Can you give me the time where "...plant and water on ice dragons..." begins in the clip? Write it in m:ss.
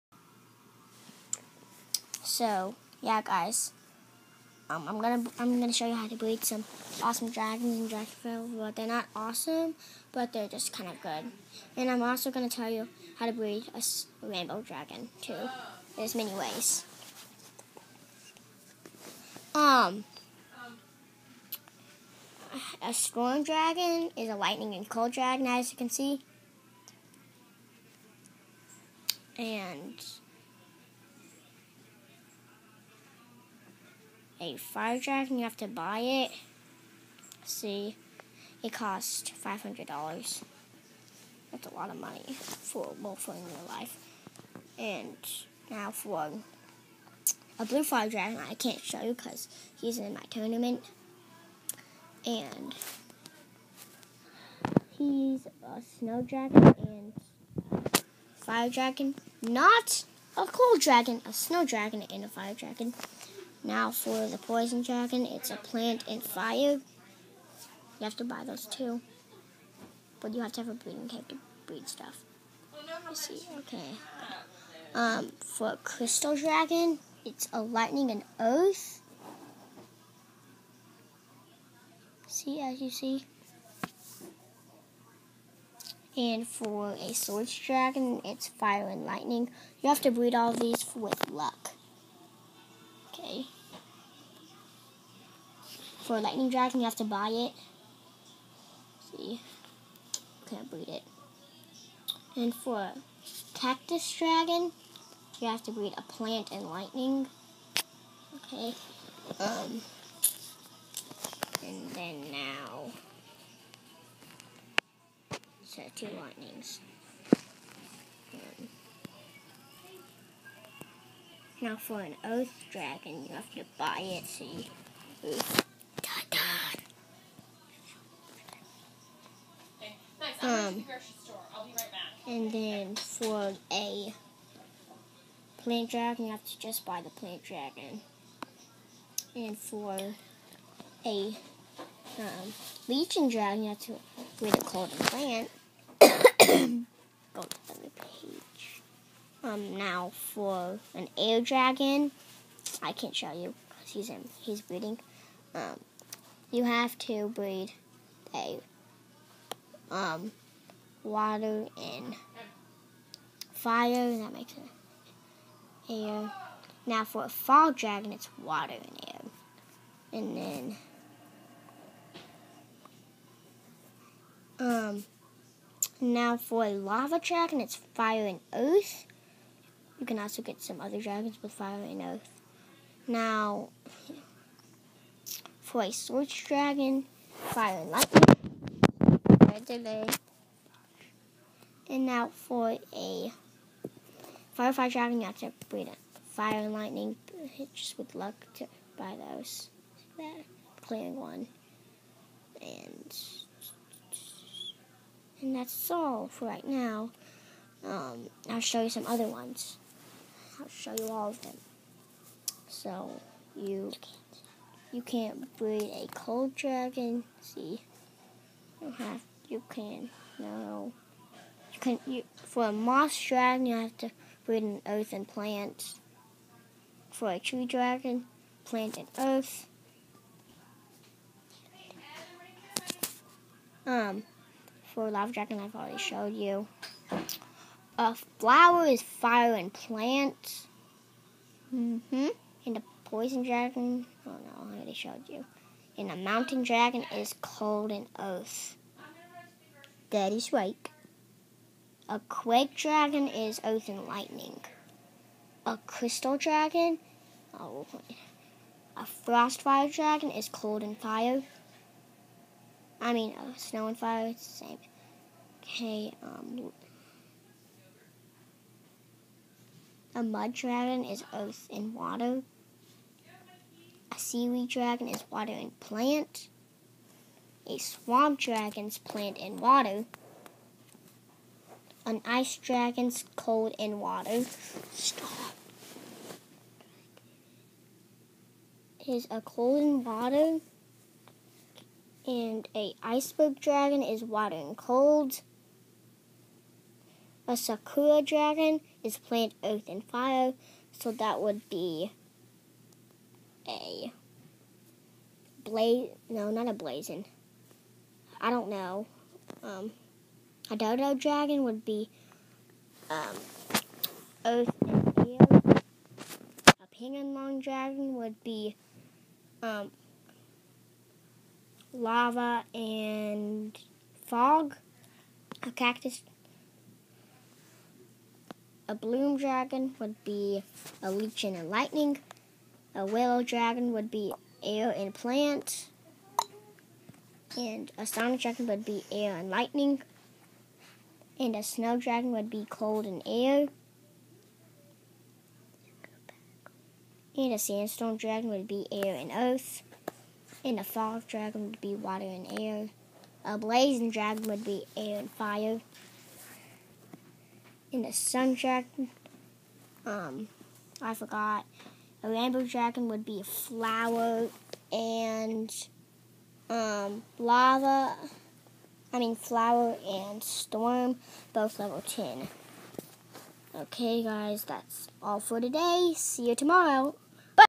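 4:38.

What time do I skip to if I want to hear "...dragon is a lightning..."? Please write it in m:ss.
0:23.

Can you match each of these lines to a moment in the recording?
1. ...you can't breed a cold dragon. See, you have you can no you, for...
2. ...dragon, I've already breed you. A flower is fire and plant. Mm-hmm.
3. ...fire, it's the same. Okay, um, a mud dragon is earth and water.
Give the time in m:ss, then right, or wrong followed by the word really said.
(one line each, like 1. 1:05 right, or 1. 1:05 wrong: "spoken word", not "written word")
1. 3:34 right
2. 3:55 wrong: "showed", not "breed"
3. 4:23 right.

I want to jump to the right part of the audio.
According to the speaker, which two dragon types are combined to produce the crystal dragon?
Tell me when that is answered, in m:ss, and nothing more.
1:17.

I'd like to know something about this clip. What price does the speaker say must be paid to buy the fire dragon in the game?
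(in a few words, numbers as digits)
$500.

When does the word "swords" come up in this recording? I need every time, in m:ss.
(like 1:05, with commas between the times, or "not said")
1:27, 3:05.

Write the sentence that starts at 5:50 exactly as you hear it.
And a fog dragon would be water and air.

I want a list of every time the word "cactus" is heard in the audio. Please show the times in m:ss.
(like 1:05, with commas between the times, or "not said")
1:43, 5:25.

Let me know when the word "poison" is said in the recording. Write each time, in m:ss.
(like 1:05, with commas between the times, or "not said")
1:04, 4:03.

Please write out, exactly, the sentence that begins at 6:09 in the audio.
I mean Flower and Storm, both level 10.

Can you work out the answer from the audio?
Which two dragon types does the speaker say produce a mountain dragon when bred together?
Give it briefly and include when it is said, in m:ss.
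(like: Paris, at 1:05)
Cold and earth, at 4:07.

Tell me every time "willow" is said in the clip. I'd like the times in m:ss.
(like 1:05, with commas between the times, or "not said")
5:33.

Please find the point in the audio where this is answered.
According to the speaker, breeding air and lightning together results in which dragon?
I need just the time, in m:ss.
5:38.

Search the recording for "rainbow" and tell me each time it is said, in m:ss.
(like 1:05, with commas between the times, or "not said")
0:14, 6:02.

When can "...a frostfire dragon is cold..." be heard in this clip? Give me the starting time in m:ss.
4:18.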